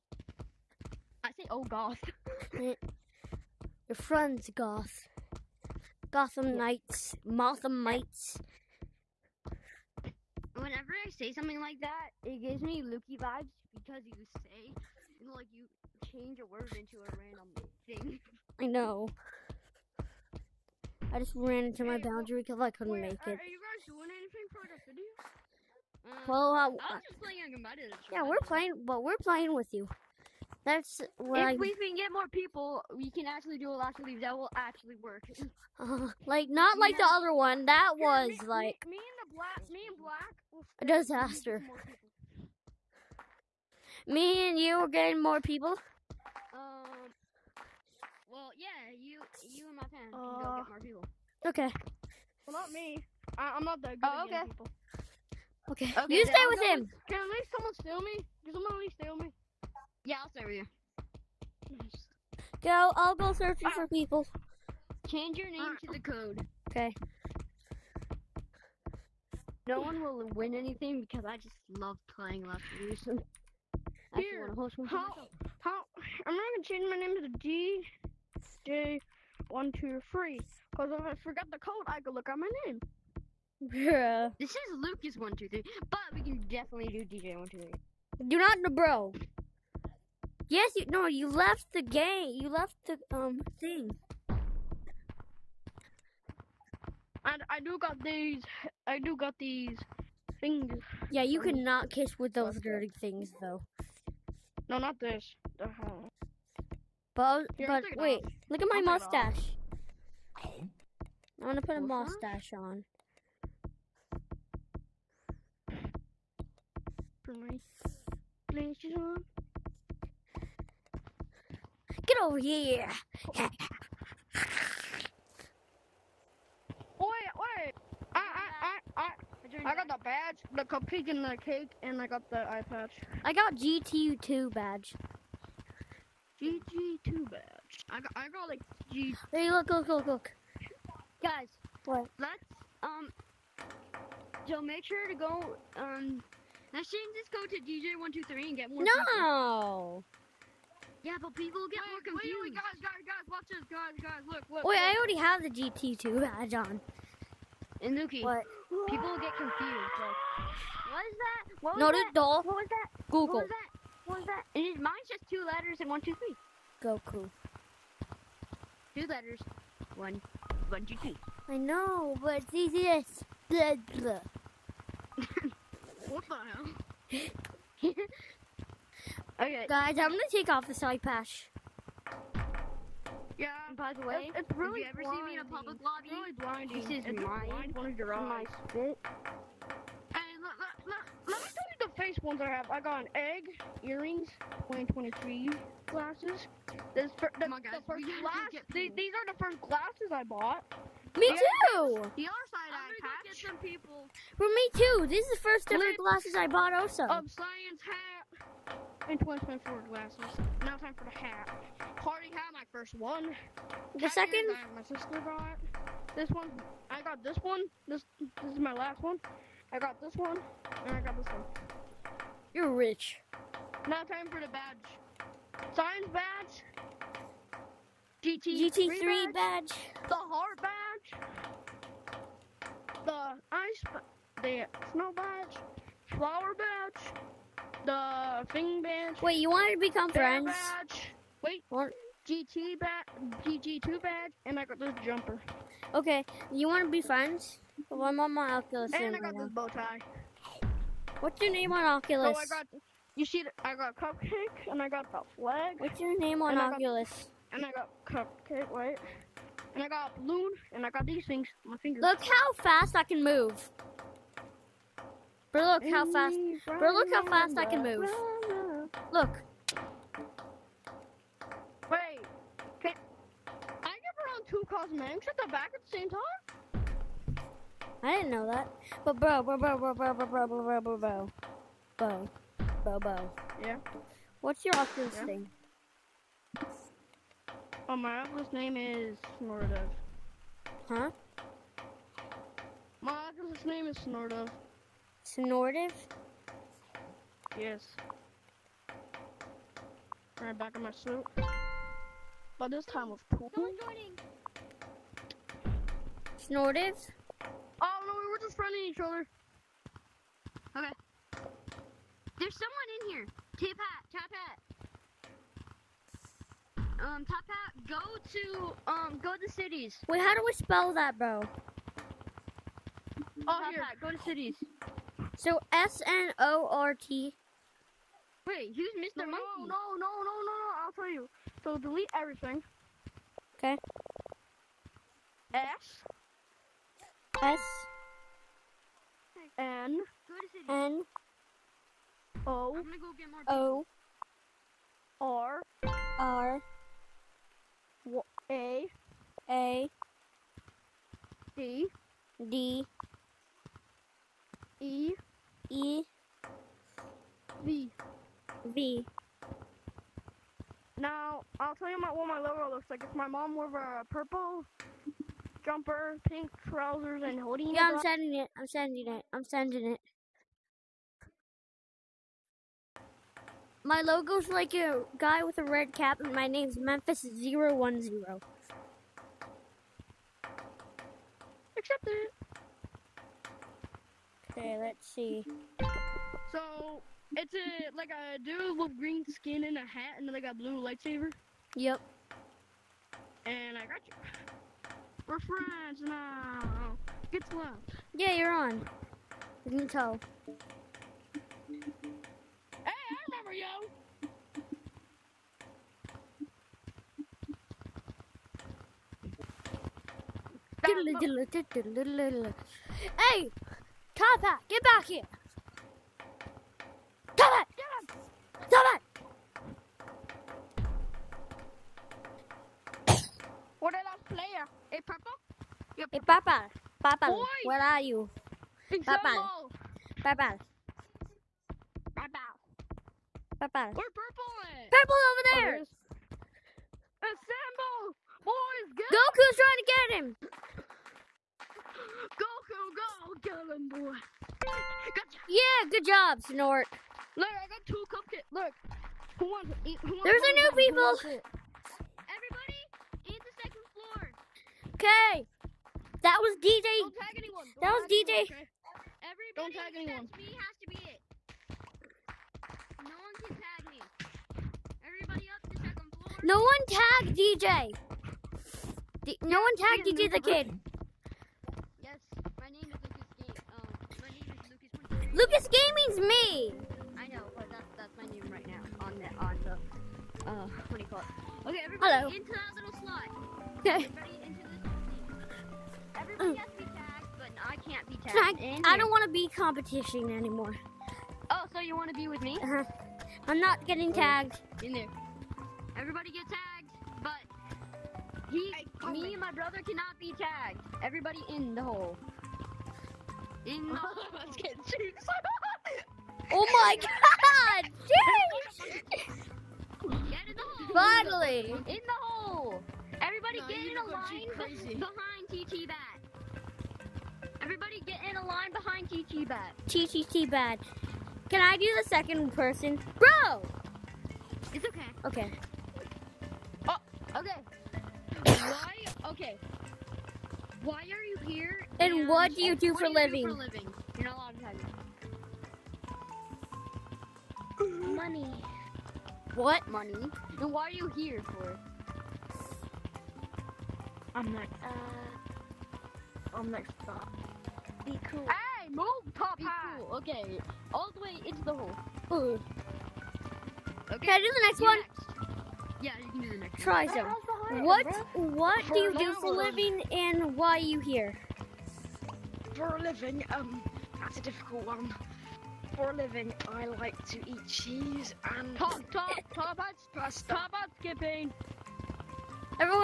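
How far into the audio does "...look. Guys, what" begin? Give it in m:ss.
2:20.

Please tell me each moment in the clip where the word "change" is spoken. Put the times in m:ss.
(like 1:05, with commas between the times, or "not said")
0:16, 1:05, 1:16.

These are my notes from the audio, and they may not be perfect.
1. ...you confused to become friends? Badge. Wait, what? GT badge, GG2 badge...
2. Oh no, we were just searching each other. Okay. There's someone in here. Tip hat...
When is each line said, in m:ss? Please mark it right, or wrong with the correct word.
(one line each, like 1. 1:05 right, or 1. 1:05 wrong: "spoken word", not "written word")
1. 3:59 wrong: "wanted", not "confused"
2. 5:07 wrong: "friending", not "searching".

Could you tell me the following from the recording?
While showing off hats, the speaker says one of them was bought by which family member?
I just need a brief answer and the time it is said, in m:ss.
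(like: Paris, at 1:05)
Sister, at 3:34.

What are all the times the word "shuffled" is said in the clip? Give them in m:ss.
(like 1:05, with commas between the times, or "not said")
not said.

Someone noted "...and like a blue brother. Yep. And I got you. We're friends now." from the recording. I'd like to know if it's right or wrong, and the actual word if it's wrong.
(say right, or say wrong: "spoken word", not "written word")
wrong: "lightsaber", not "brother".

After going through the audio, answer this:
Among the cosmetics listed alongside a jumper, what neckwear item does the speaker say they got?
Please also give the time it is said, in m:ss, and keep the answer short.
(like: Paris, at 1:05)
Bow tie, at 4:09.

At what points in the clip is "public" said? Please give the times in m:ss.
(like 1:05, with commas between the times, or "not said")
3:05.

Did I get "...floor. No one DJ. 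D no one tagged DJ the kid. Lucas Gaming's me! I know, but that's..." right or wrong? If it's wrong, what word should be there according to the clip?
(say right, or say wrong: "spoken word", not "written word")
right.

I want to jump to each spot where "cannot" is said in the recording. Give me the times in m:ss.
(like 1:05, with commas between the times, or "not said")
1:41, 8:19.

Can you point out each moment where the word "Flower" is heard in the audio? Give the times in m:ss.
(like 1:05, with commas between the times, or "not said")
3:56.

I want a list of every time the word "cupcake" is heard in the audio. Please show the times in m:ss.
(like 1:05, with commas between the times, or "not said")
2:10, 4:13, 4:18, 7:28.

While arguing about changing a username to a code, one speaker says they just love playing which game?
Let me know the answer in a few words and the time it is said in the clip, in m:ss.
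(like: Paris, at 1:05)
Last Evolution, at 1:12.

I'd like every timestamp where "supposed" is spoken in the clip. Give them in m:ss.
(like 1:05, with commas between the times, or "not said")
not said.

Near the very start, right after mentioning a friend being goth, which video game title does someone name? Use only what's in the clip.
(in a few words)
Gotham Knights.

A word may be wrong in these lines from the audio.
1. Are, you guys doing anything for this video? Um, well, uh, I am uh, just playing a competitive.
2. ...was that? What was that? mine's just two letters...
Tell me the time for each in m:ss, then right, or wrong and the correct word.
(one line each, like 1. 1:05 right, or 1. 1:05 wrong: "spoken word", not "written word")
1. 0:23 right
2. 2:43 right.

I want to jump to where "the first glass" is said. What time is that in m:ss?
3:17.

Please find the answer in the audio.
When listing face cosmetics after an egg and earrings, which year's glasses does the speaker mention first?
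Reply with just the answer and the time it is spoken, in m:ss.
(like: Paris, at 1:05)
2023, at 3:14.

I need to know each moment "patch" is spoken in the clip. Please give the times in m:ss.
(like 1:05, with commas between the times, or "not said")
2:12, 3:01, 3:23.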